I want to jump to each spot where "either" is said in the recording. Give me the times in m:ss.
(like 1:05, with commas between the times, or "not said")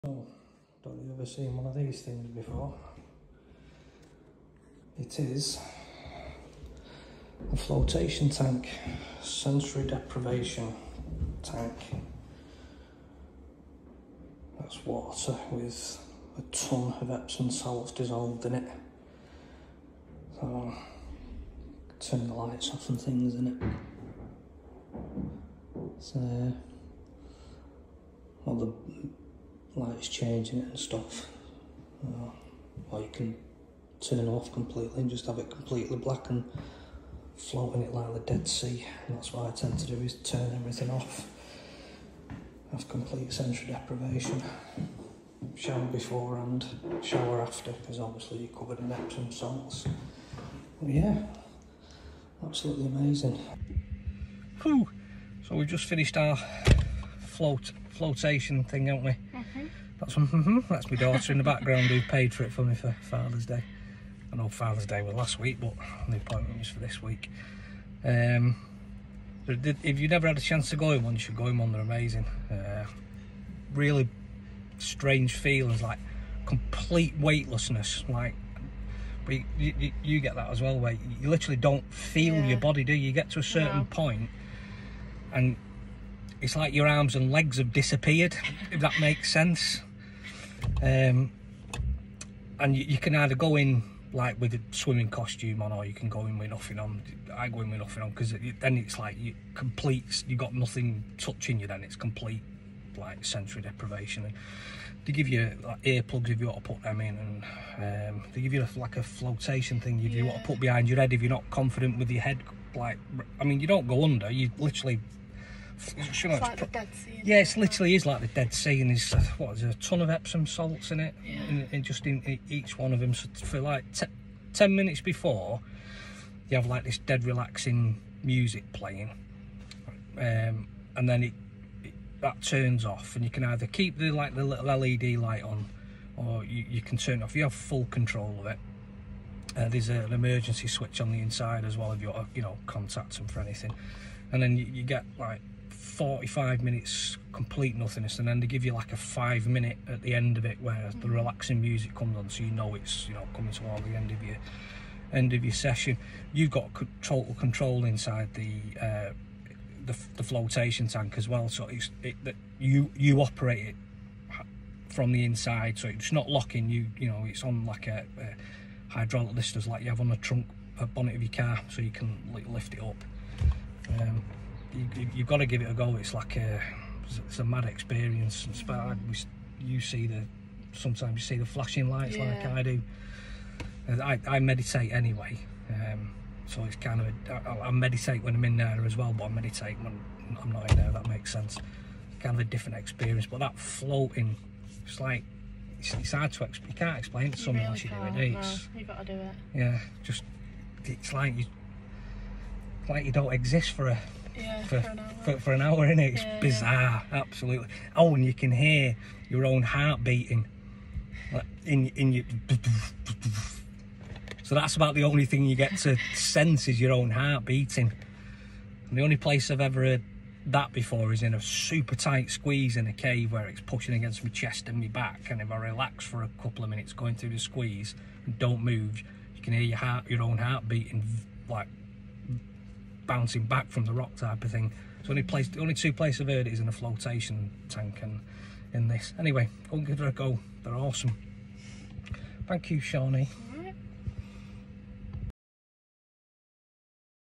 1:33, 2:13.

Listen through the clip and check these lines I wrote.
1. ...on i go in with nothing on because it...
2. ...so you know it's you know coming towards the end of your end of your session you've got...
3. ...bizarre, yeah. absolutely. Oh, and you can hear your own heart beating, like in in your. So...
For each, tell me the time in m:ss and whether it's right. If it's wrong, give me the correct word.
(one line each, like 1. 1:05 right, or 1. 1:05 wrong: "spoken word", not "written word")
1. 1:36 right
2. 2:32 right
3. 3:26 right.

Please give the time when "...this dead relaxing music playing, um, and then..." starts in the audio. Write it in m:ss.
2:06.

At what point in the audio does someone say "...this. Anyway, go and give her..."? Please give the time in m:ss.
3:58.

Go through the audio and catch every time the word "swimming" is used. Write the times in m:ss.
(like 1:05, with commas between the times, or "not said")
1:34.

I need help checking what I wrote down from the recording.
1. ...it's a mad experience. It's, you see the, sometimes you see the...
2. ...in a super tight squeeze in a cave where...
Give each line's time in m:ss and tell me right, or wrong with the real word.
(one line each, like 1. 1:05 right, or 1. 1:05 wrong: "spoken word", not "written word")
1. 2:57 right
2. 3:41 right.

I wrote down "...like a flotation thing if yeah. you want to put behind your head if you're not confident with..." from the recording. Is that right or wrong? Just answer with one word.
right.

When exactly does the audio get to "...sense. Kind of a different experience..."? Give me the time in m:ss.
3:11.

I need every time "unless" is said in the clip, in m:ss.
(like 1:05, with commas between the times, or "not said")
3:17.